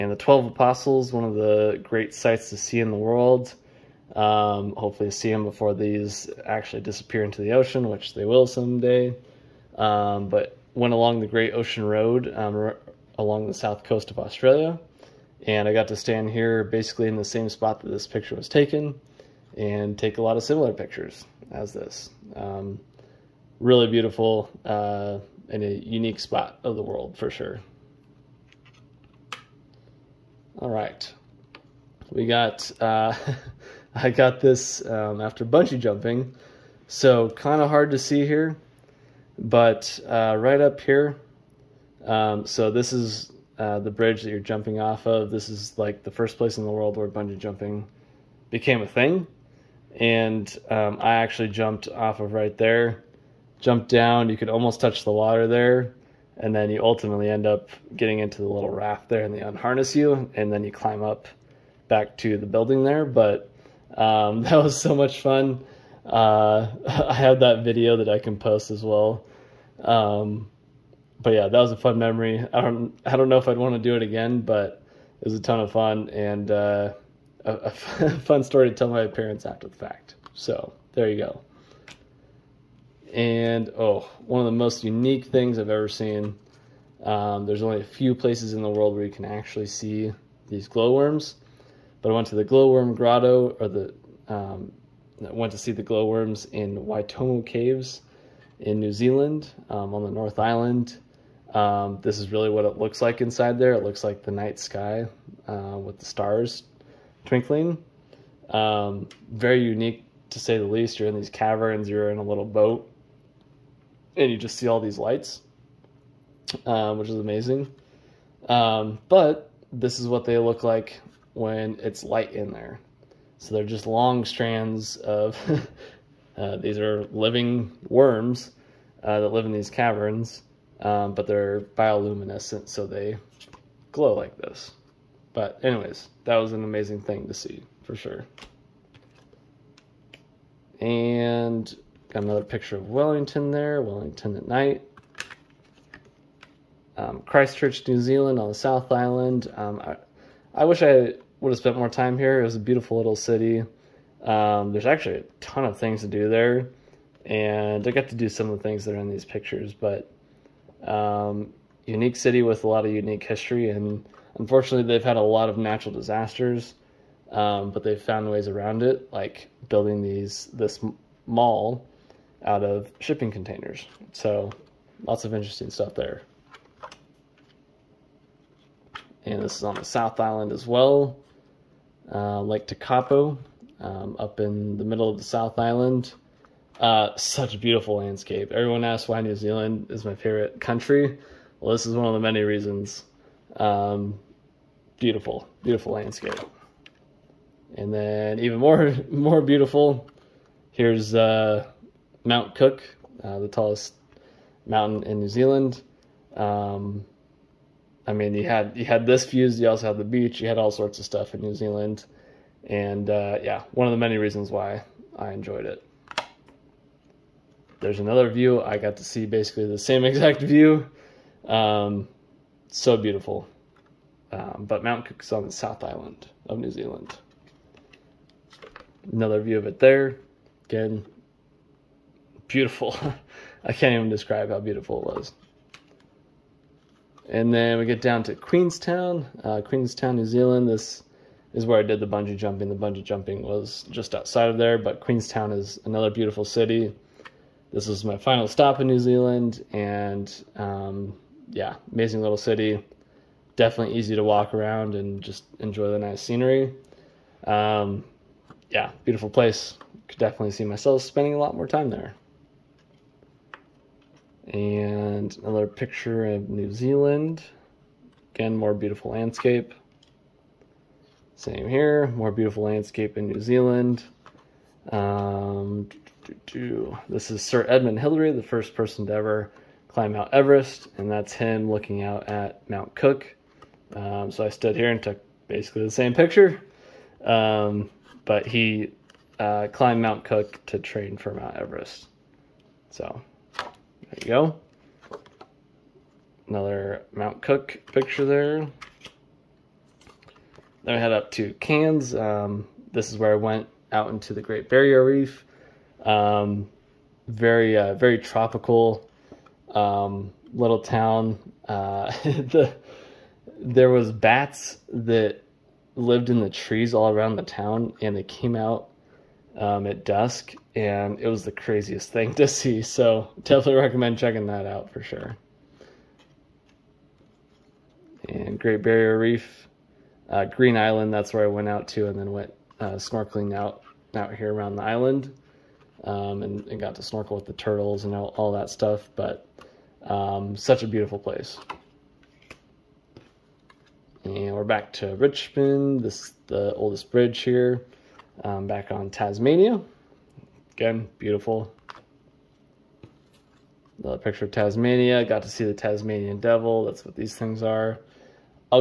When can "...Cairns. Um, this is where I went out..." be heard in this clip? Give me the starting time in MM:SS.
05:01.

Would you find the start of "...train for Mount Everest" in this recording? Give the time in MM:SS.
04:50.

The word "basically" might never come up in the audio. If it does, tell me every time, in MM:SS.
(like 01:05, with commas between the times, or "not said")
00:16, 03:39, 04:45.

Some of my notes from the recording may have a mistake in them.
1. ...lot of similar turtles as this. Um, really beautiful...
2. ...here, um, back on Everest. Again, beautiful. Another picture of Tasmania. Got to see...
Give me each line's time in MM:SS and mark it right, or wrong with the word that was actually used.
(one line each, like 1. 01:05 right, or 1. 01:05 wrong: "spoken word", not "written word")
1. 00:20 wrong: "pictures", not "turtles"
2. 05:47 wrong: "Tasmania", not "Everest".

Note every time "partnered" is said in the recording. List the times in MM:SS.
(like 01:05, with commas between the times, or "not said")
not said.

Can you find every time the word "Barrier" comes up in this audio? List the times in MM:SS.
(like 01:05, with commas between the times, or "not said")
05:04, 05:28.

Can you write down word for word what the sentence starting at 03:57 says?
And then we get down to Queenstown, uh, Queenstown, New Zealand.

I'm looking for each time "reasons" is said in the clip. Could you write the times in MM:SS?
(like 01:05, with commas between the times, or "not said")
03:12, 03:34.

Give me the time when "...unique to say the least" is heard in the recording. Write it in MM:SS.
01:49.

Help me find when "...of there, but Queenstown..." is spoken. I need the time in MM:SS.
04:04.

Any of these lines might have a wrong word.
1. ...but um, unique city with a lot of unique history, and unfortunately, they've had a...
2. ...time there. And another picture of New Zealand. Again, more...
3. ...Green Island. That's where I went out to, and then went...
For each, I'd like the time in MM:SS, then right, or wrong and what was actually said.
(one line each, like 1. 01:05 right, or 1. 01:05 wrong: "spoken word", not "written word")
1. 02:39 right
2. 04:21 right
3. 05:30 right.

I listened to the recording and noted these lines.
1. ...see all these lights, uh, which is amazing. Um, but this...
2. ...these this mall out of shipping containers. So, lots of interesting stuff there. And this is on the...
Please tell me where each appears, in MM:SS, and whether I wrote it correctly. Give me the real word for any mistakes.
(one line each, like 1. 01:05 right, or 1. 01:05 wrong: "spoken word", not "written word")
1. 01:54 right
2. 02:50 right.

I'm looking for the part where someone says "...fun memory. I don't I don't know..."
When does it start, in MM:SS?
01:11.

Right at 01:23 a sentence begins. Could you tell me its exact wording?
And oh, one of the most unique things I've ever seen.